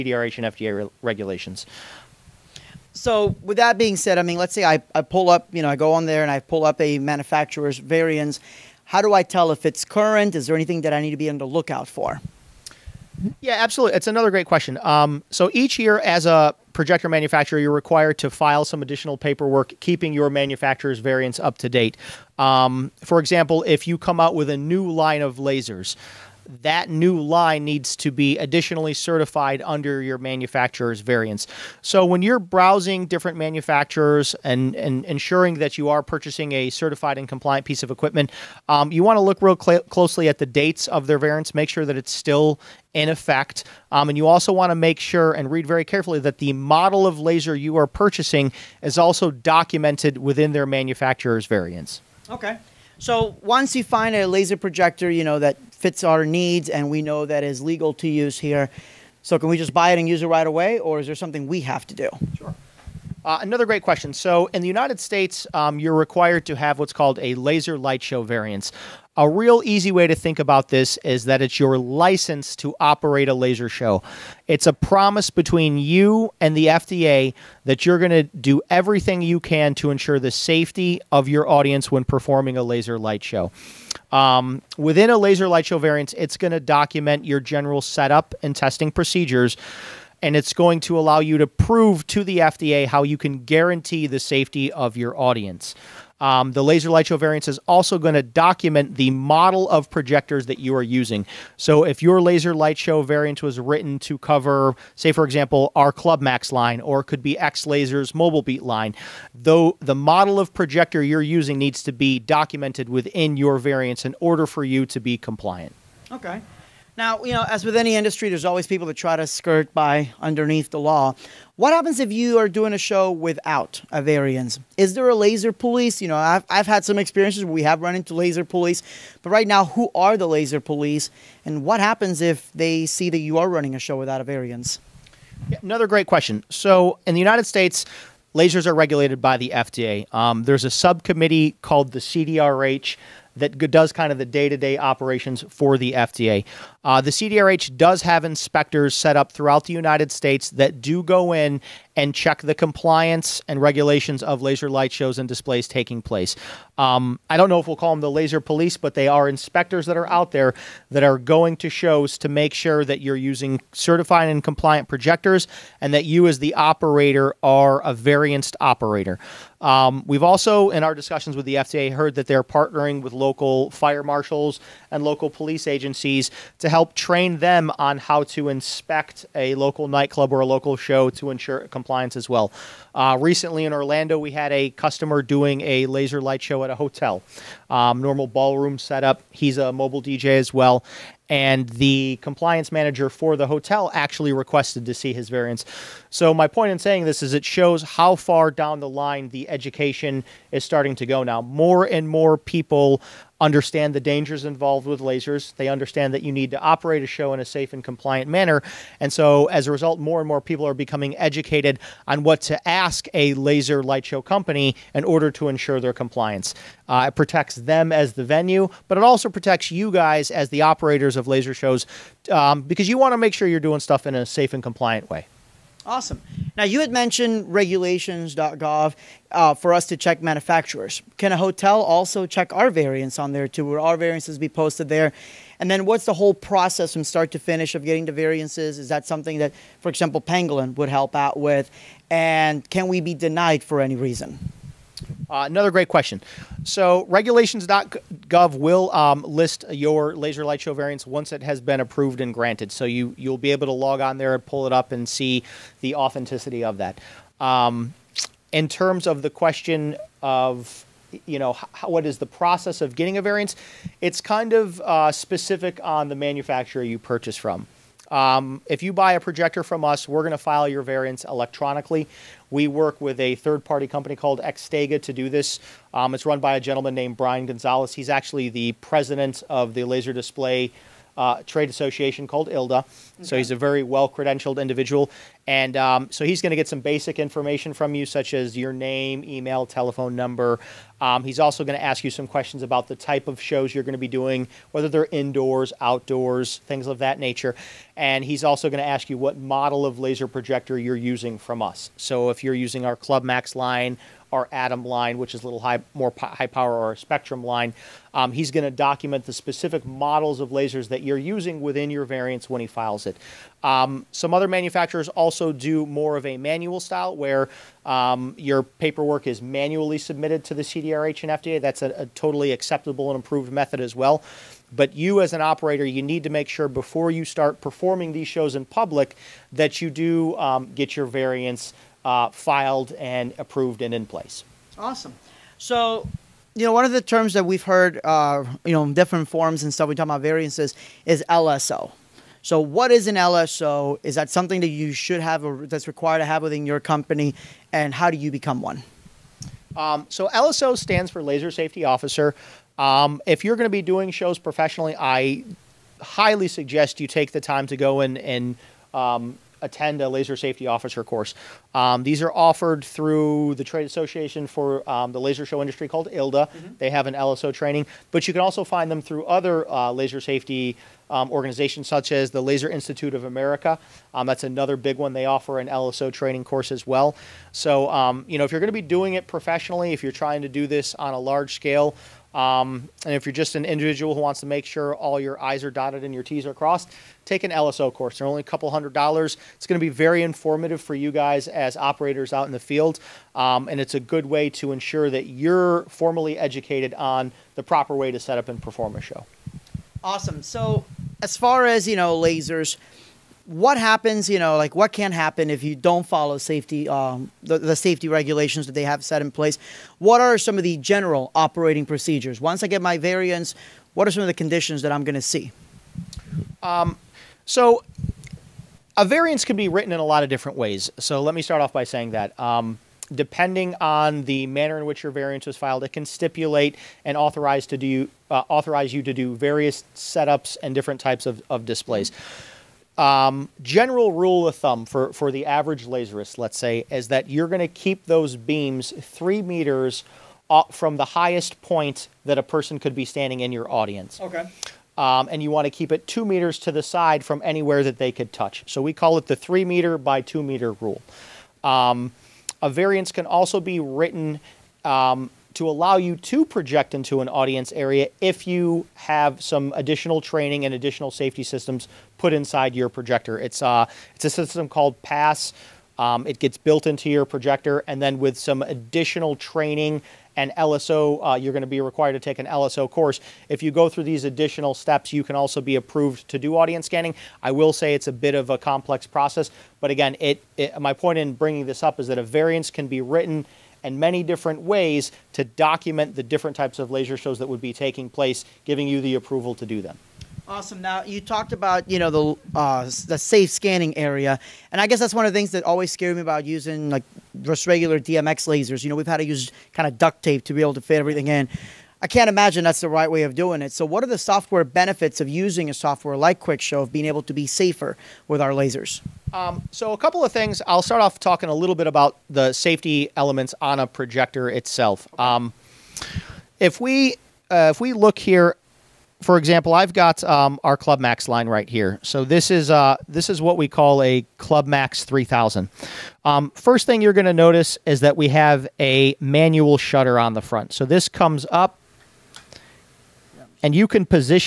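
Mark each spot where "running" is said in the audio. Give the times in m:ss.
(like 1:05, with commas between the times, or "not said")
2:13.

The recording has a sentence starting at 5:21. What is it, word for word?
That's a, a totally acceptable and approved method as well.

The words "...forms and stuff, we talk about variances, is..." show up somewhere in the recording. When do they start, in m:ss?
5:39.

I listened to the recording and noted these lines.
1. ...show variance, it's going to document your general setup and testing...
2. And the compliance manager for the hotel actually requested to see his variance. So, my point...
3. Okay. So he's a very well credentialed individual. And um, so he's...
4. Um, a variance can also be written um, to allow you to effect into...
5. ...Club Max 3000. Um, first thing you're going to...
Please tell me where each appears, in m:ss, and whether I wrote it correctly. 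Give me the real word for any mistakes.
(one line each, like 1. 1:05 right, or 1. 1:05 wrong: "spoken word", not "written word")
1. 1:25 right
2. 3:11 right
3. 4:42 right
4. 7:31 wrong: "project", not "effect"
5. 8:44 right.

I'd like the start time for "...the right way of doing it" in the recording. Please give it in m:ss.
8:22.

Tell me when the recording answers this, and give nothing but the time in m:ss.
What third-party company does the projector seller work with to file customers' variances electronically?
4:34.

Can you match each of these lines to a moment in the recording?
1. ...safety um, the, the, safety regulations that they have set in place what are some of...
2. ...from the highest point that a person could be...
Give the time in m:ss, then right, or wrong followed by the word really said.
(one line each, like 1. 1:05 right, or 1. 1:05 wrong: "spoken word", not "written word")
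1. 6:46 right
2. 7:20 right.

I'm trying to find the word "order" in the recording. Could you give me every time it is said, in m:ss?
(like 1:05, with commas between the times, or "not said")
1:54, 3:35.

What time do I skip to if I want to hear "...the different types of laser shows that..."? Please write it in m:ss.
8:06.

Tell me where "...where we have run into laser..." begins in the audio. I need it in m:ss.
2:07.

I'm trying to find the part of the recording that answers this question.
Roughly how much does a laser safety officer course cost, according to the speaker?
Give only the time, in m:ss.
6:28.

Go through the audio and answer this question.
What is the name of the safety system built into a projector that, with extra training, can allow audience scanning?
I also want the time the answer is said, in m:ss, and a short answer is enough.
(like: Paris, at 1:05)
Pass, at 7:45.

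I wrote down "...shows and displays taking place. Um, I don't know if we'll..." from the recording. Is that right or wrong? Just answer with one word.
right.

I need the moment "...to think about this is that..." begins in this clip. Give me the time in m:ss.
1:10.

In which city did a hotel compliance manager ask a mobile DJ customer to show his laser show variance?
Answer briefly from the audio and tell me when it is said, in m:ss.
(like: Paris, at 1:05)
Orlando, at 3:03.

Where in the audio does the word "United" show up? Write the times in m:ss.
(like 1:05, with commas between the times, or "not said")
1:04, 2:17, 2:29.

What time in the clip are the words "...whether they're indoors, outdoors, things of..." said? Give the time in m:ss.
4:54.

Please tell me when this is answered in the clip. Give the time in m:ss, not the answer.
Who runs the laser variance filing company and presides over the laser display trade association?
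4:37.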